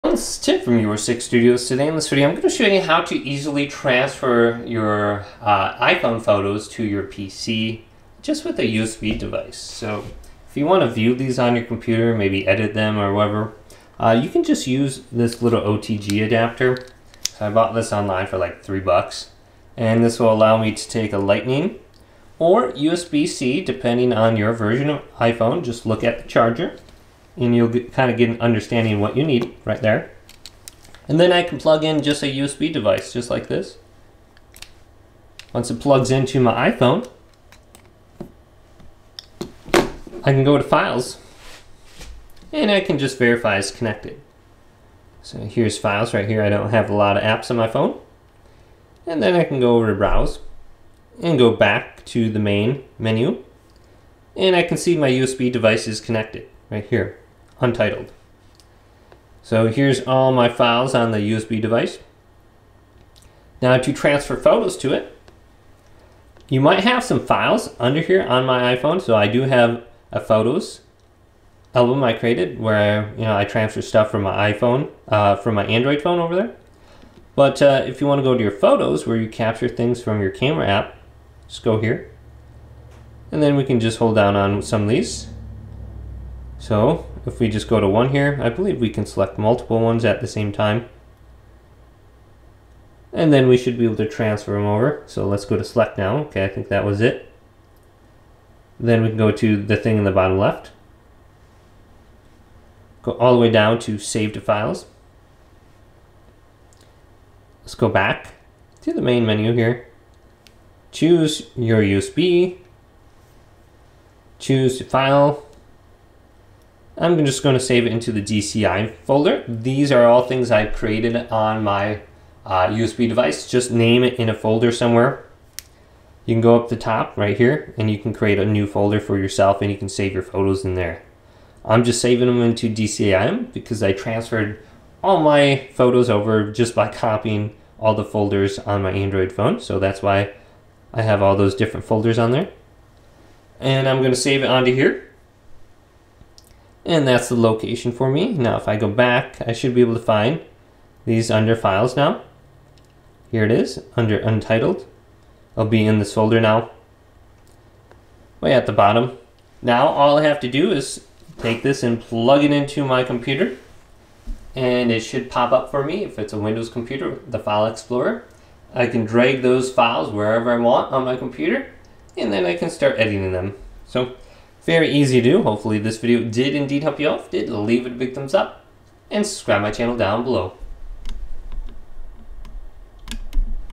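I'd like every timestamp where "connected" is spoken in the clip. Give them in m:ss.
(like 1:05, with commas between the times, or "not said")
0:43, 0:55.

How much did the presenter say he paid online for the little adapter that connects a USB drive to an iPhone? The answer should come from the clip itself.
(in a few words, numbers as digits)
$3.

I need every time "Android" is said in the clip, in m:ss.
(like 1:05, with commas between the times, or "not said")
1:15, 2:18.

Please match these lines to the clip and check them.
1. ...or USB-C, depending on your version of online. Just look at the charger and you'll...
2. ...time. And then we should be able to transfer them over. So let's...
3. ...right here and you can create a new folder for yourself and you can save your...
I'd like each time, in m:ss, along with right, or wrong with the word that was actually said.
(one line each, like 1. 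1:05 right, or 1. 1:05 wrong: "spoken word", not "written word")
1. 0:22 wrong: "iPhone", not "online"
2. 1:30 right
3. 2:07 right.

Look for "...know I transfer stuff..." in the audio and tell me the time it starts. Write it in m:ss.
1:13.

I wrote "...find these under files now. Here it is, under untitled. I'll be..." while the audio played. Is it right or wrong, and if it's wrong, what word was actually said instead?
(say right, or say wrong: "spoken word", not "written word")
right.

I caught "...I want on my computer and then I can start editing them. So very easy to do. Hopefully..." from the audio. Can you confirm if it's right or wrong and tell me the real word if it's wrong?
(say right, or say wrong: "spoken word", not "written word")
right.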